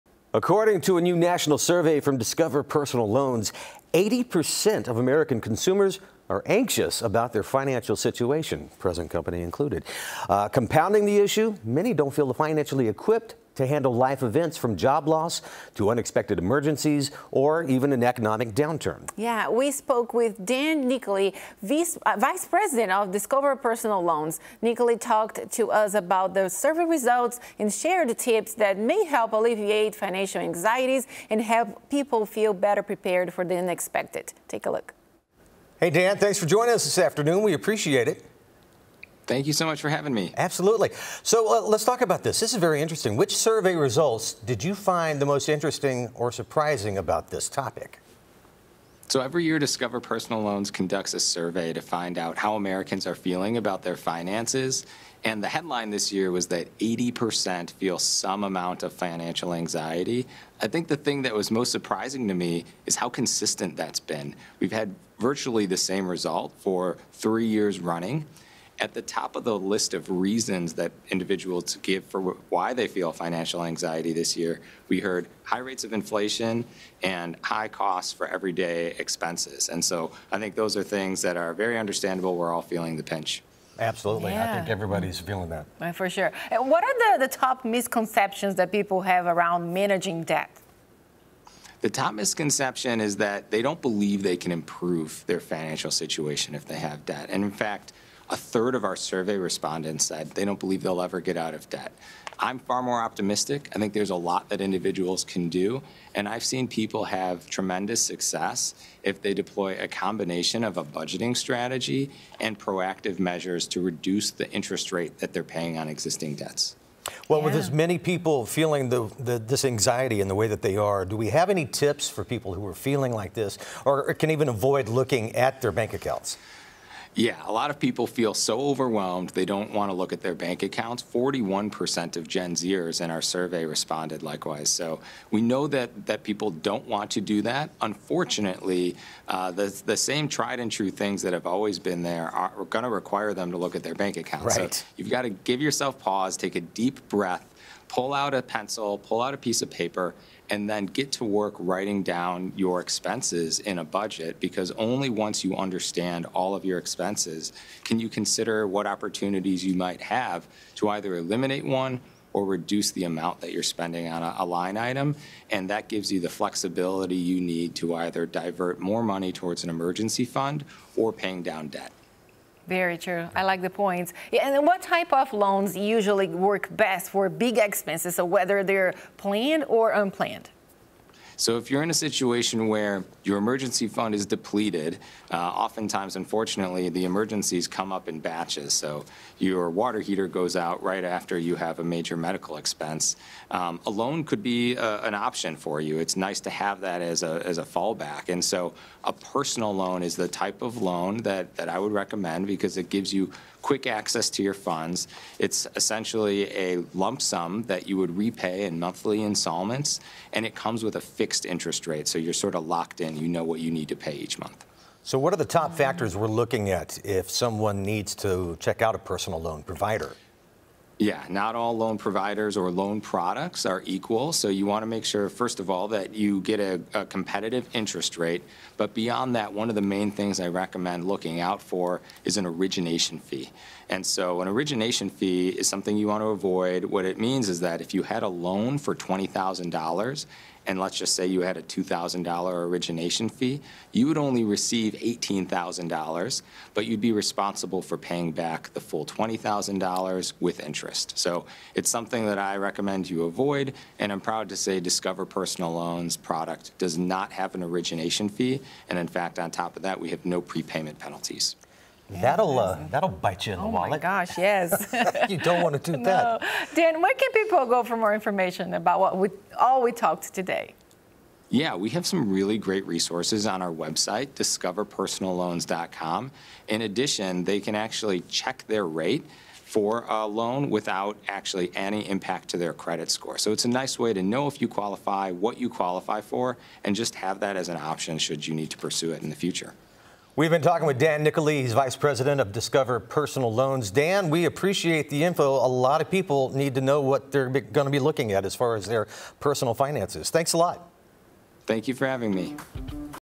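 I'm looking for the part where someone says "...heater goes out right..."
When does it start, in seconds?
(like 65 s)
190 s.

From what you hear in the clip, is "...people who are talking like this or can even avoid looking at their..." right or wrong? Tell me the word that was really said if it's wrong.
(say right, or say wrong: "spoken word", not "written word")
wrong: "feeling", not "talking".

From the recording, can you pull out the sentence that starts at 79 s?
And so I think those are things that are very understandable.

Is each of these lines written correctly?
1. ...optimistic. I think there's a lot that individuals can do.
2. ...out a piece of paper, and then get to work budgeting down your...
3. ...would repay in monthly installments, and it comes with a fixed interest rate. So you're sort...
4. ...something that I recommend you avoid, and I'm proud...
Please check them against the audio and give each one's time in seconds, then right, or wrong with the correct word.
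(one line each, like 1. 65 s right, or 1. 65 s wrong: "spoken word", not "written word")
1. 103 s right
2. 149 s wrong: "writing", not "budgeting"
3. 207 s right
4. 251 s right.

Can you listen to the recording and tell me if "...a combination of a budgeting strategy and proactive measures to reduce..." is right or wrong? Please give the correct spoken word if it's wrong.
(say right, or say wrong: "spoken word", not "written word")
right.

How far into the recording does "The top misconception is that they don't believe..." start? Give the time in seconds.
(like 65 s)
91 s.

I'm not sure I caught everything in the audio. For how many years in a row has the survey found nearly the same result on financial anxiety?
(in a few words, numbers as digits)
3 years.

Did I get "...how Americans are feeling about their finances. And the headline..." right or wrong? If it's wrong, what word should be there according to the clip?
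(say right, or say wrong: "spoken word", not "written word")
right.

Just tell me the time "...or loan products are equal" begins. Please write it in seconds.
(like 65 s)
222 s.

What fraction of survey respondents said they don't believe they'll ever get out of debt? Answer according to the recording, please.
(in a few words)
a third.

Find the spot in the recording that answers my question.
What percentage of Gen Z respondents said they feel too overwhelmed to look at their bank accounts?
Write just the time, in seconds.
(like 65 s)
131 s.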